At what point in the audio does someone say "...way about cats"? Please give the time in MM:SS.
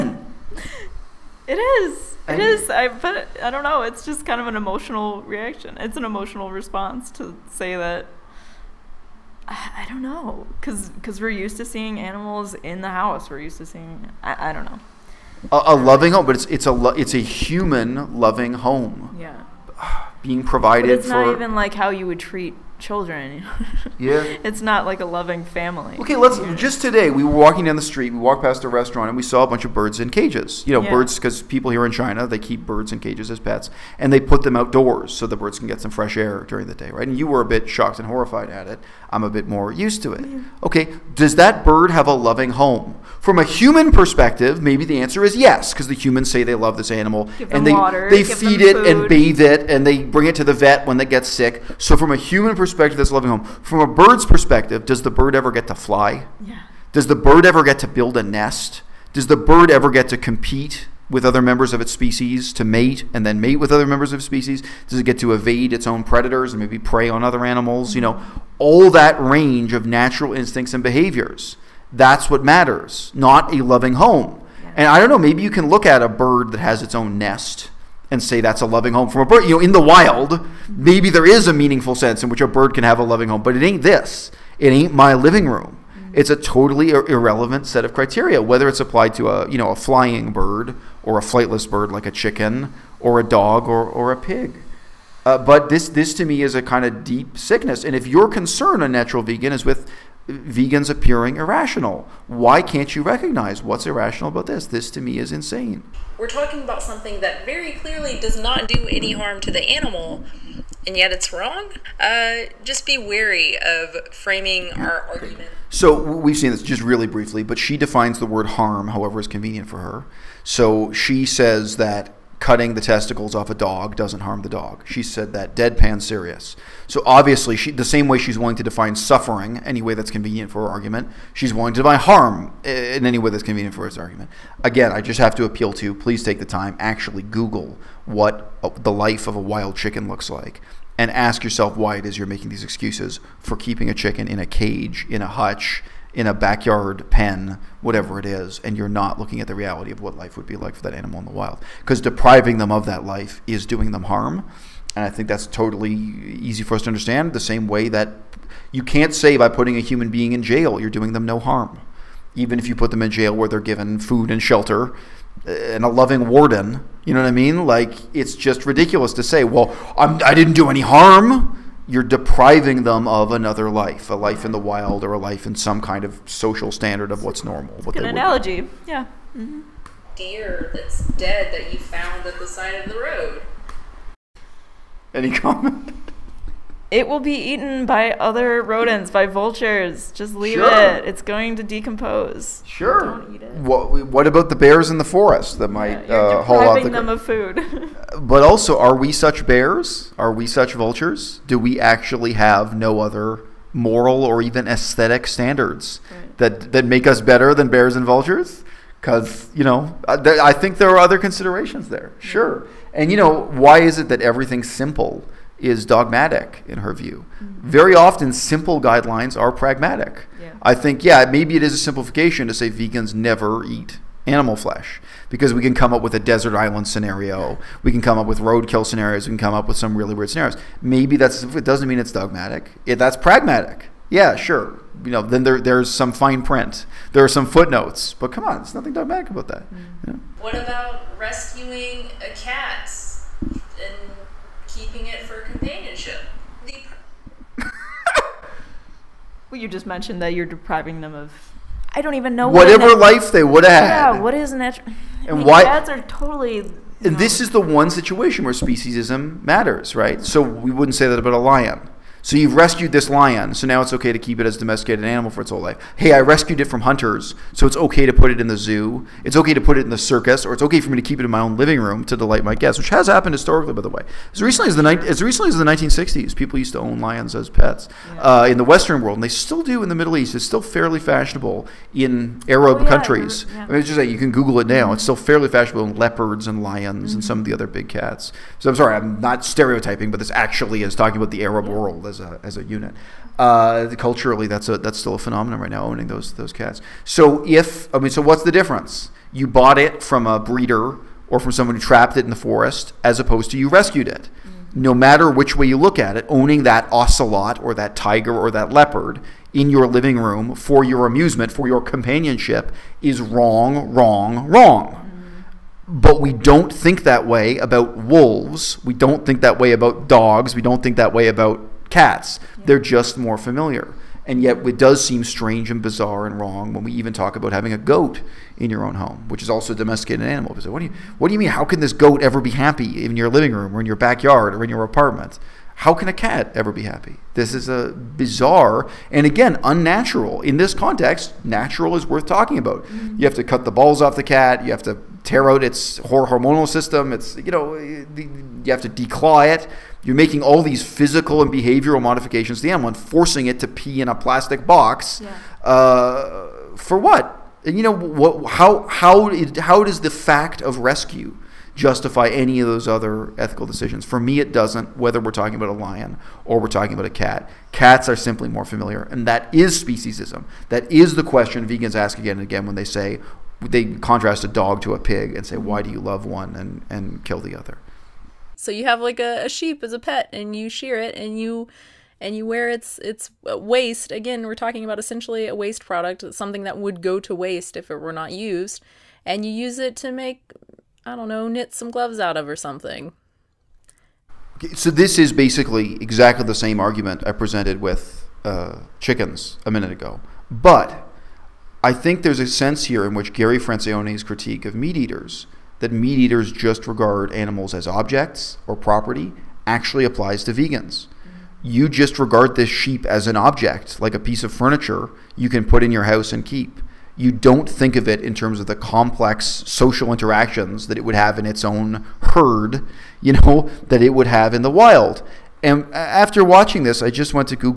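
05:21.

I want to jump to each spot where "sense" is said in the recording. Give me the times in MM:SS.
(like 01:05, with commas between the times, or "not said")
01:21, 06:42.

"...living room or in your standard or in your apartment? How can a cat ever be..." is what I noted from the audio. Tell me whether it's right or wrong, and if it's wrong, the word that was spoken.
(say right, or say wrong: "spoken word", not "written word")
wrong: "backyard", not "standard".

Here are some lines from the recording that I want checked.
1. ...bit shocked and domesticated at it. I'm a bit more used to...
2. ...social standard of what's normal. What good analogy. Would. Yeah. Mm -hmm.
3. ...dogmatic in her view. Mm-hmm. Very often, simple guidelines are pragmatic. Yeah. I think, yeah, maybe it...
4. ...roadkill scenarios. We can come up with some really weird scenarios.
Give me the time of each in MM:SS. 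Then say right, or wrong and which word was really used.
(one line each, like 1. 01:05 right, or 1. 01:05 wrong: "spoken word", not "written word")
1. 00:37 wrong: "horrified", not "domesticated"
2. 02:56 right
3. 03:35 right
4. 03:48 right.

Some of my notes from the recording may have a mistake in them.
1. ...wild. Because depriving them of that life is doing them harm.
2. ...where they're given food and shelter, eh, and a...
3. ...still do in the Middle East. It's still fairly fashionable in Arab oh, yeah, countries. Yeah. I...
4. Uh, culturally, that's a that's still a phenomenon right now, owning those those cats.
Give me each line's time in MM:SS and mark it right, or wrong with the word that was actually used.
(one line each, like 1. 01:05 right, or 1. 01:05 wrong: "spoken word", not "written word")
1. 02:31 right
2. 02:43 right
3. 04:39 right
4. 04:53 right.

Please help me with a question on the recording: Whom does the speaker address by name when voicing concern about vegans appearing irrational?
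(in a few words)
Unnatural Vegan.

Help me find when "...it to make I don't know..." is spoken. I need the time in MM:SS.
06:29.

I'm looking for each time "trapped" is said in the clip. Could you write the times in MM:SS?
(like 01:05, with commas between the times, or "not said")
05:01.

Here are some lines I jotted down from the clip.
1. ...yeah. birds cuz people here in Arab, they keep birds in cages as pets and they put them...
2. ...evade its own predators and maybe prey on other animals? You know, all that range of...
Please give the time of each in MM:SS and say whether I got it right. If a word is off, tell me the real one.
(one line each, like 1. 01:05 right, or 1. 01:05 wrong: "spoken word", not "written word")
1. 00:30 wrong: "China", not "Arab"
2. 01:05 right.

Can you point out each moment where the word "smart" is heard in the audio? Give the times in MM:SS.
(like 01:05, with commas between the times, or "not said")
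not said.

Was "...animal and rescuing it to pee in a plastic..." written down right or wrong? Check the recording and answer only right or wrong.
wrong.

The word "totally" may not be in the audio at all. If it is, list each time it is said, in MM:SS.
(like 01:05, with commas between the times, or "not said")
01:26, 02:35, 04:16.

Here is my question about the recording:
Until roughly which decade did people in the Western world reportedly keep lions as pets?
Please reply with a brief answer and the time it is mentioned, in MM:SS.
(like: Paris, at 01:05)
1960s, at 04:35.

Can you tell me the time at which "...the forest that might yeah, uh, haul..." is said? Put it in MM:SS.
03:14.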